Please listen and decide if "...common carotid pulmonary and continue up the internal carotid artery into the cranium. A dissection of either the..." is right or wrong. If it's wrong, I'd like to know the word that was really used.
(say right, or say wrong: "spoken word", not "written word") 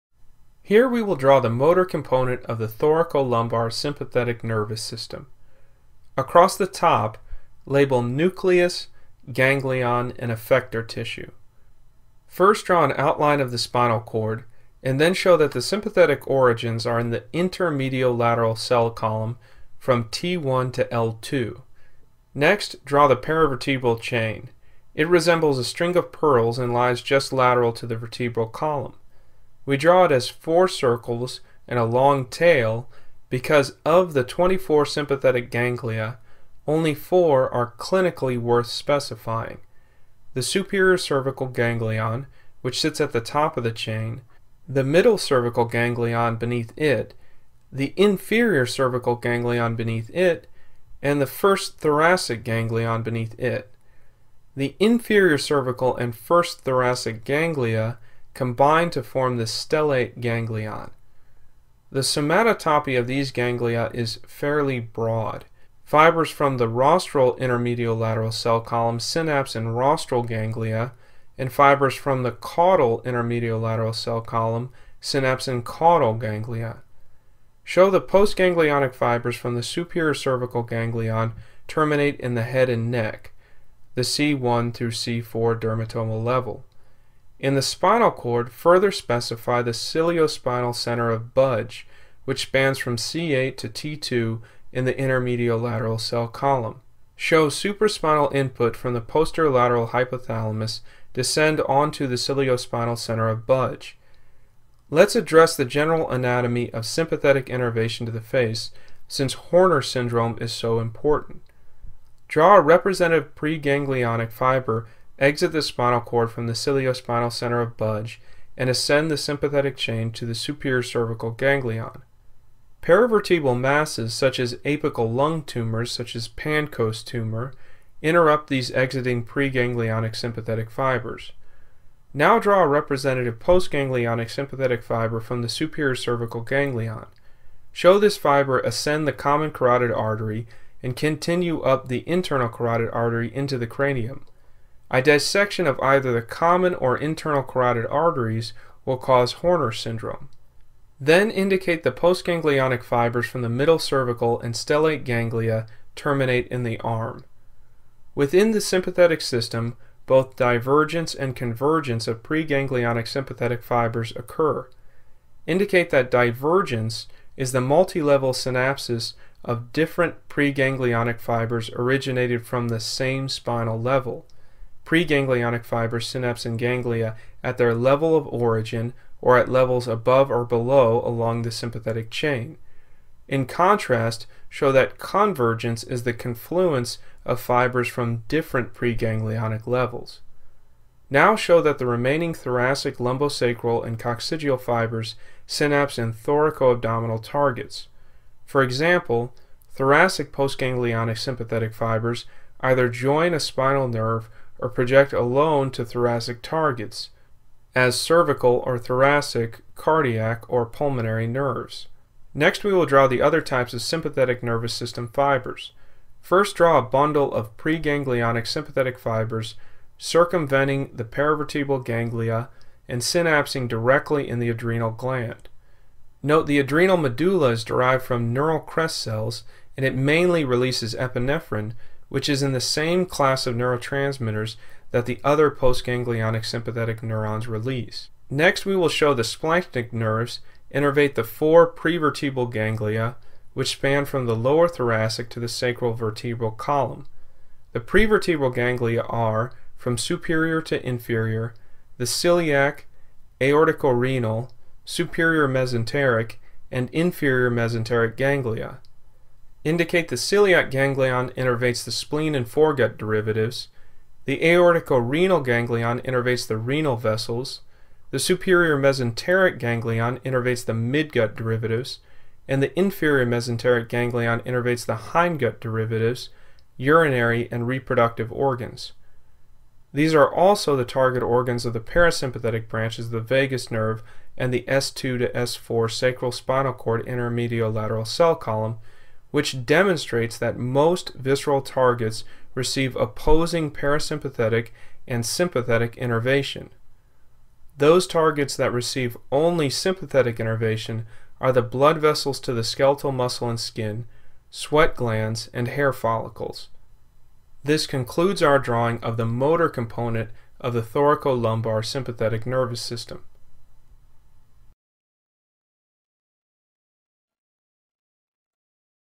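wrong: "artery", not "pulmonary".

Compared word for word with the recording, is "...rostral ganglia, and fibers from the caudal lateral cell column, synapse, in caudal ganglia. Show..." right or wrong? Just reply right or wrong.
right.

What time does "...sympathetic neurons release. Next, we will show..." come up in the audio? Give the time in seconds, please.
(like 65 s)
236 s.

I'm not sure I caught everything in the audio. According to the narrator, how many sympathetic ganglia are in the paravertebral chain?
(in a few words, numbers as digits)
24.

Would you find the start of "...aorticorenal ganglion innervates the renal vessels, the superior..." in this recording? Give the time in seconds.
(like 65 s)
264 s.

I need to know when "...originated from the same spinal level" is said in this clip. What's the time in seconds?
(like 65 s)
171 s.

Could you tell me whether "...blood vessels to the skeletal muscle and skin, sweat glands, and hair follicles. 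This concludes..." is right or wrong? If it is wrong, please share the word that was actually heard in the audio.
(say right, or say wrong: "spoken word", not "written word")
right.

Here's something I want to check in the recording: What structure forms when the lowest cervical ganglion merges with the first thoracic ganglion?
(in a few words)
stellate ganglion.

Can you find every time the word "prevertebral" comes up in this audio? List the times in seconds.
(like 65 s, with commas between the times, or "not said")
241 s, 247 s.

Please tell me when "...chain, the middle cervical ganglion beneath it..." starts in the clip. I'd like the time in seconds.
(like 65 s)
43 s.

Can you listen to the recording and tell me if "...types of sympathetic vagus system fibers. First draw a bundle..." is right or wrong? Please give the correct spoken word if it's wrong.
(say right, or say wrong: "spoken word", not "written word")
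wrong: "nervous", not "vagus".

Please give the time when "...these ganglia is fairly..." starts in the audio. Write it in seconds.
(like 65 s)
63 s.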